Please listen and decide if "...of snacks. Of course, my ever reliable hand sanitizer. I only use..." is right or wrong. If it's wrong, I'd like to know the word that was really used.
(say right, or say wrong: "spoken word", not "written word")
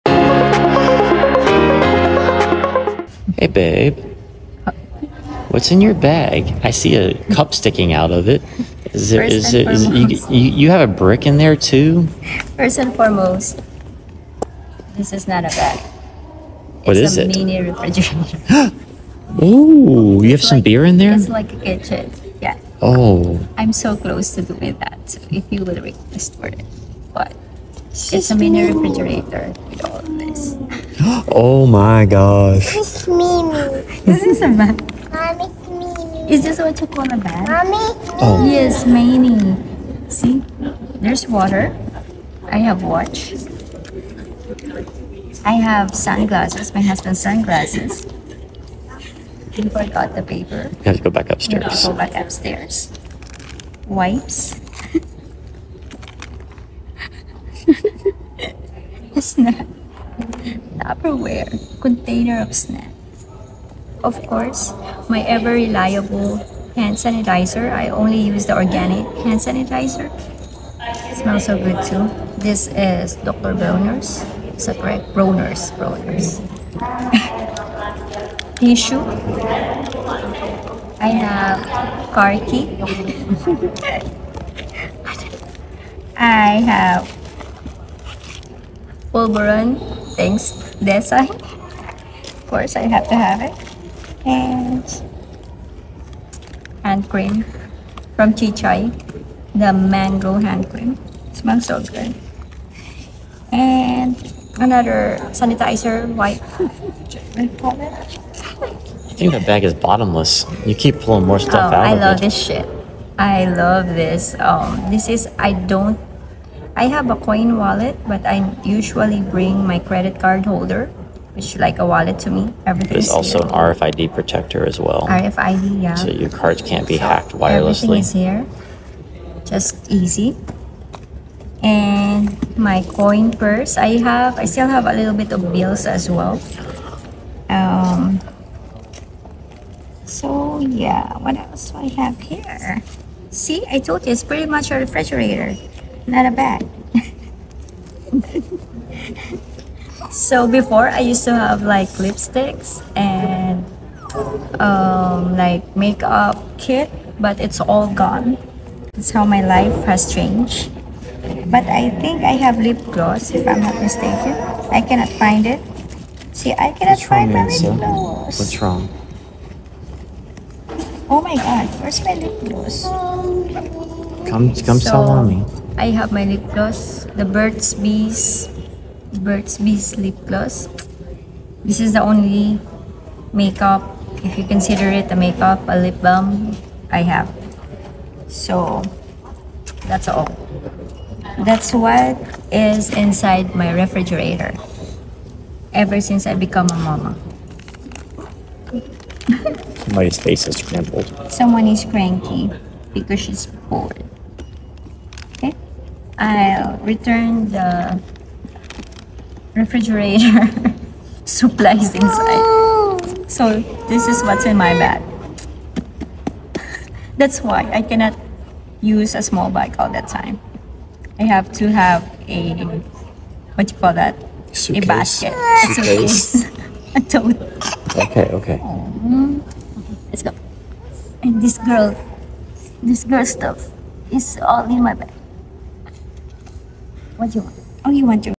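right.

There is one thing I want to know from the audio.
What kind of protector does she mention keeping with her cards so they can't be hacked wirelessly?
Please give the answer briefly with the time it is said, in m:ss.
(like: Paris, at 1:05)
RFID protector, at 2:03.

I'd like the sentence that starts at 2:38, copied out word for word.
That's how my life has changed.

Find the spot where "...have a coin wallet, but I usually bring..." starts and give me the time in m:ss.
1:56.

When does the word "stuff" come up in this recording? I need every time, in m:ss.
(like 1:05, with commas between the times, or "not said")
1:51, 3:53.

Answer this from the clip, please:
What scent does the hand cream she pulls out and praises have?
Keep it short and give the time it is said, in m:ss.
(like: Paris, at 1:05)
Mango, at 1:39.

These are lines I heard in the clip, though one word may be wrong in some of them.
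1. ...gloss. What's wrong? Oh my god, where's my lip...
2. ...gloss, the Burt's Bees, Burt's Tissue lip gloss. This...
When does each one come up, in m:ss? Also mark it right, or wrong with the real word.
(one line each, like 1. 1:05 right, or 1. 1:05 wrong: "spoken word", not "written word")
1. 2:47 right
2. 2:56 wrong: "Bees", not "Tissue".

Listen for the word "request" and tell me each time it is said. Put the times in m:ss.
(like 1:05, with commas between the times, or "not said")
0:25.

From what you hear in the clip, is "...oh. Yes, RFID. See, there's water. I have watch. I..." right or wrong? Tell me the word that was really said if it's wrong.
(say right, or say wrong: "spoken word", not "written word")
wrong: "Mimi", not "RFID".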